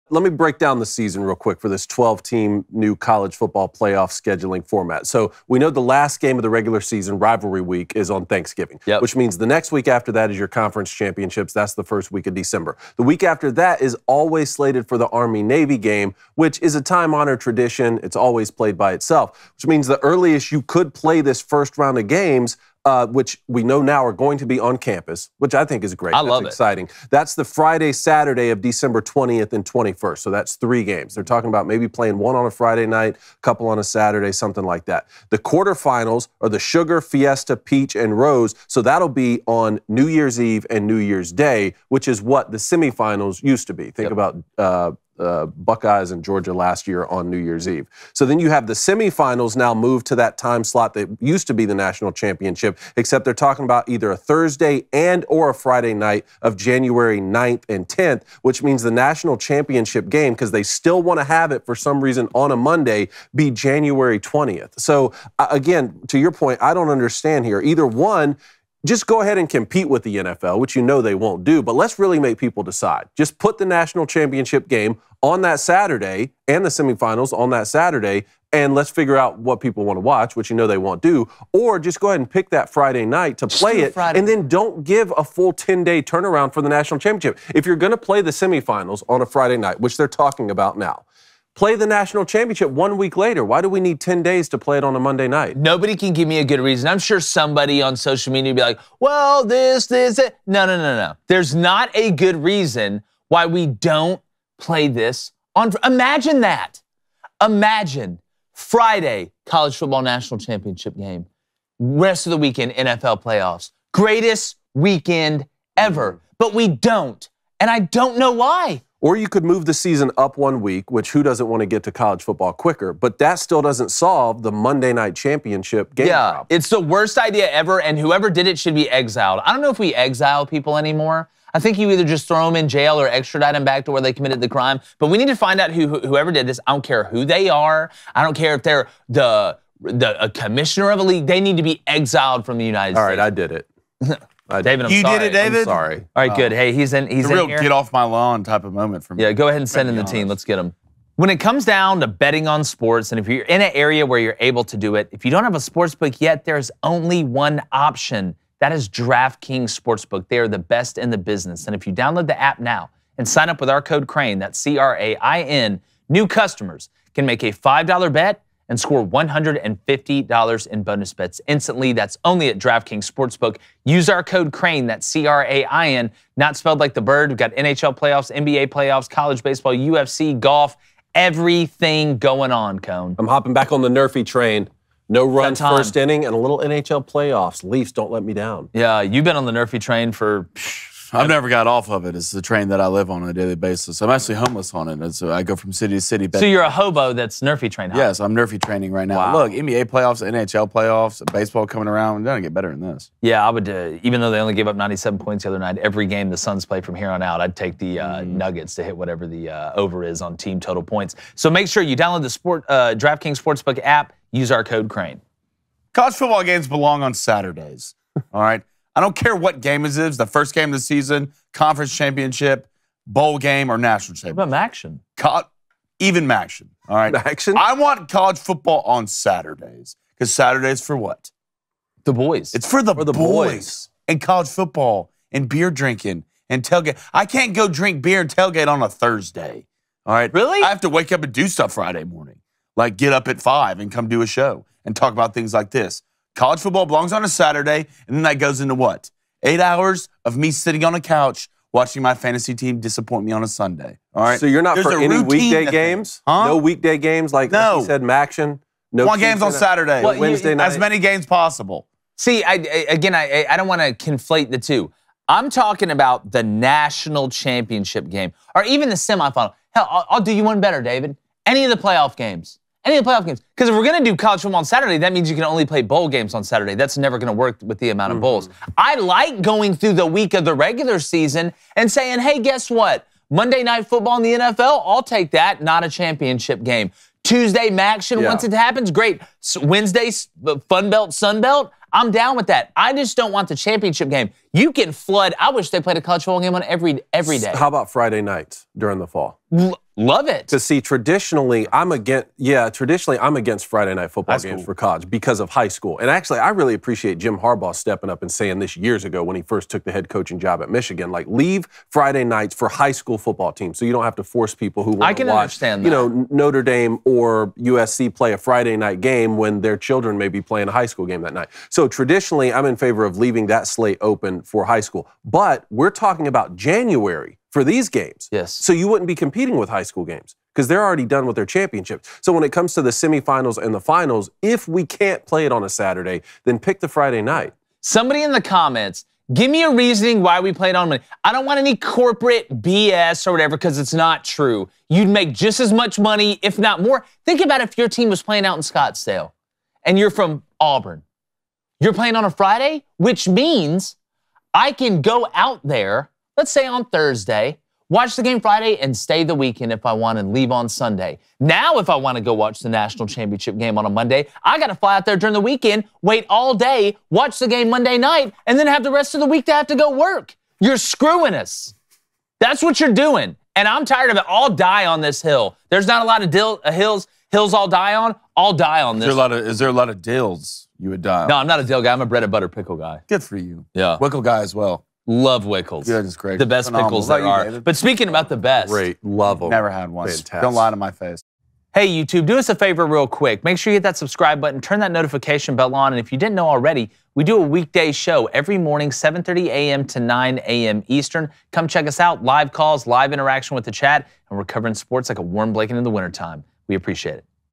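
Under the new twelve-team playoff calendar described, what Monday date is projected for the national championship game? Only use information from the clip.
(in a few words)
January 20th.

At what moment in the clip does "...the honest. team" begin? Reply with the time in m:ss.
2:29.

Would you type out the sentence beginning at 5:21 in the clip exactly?
So traditionally, I'm in favor of leaving that slate open for high school.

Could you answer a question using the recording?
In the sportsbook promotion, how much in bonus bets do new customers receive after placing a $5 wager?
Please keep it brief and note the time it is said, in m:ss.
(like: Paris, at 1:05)
$150, at 2:49.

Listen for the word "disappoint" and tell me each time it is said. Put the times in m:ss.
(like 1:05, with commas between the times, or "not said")
4:12.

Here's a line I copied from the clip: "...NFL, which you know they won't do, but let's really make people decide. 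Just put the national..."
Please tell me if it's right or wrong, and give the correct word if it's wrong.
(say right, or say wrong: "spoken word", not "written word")
right.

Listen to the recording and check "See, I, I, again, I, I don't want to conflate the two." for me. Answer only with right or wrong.
right.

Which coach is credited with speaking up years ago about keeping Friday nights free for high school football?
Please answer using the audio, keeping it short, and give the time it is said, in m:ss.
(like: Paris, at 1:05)
Jim Harbaugh, at 5:07.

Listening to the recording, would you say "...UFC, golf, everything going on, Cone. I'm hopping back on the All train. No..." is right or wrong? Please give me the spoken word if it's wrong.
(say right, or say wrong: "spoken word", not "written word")
wrong: "Nerfy", not "All".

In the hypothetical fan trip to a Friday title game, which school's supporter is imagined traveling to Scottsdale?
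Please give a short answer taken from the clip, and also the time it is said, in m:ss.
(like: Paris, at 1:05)
Auburn, at 5:50.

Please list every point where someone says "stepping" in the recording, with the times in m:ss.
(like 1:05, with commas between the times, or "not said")
5:07.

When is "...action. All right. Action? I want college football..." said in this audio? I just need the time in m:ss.
3:46.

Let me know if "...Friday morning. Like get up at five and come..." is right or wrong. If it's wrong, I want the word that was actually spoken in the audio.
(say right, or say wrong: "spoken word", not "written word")
right.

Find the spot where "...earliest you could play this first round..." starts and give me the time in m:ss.
0:20.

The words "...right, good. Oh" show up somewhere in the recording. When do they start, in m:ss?
2:26.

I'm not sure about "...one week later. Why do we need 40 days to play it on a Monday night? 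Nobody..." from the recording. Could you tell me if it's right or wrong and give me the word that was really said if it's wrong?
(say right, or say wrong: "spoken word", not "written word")
wrong: "10", not "40".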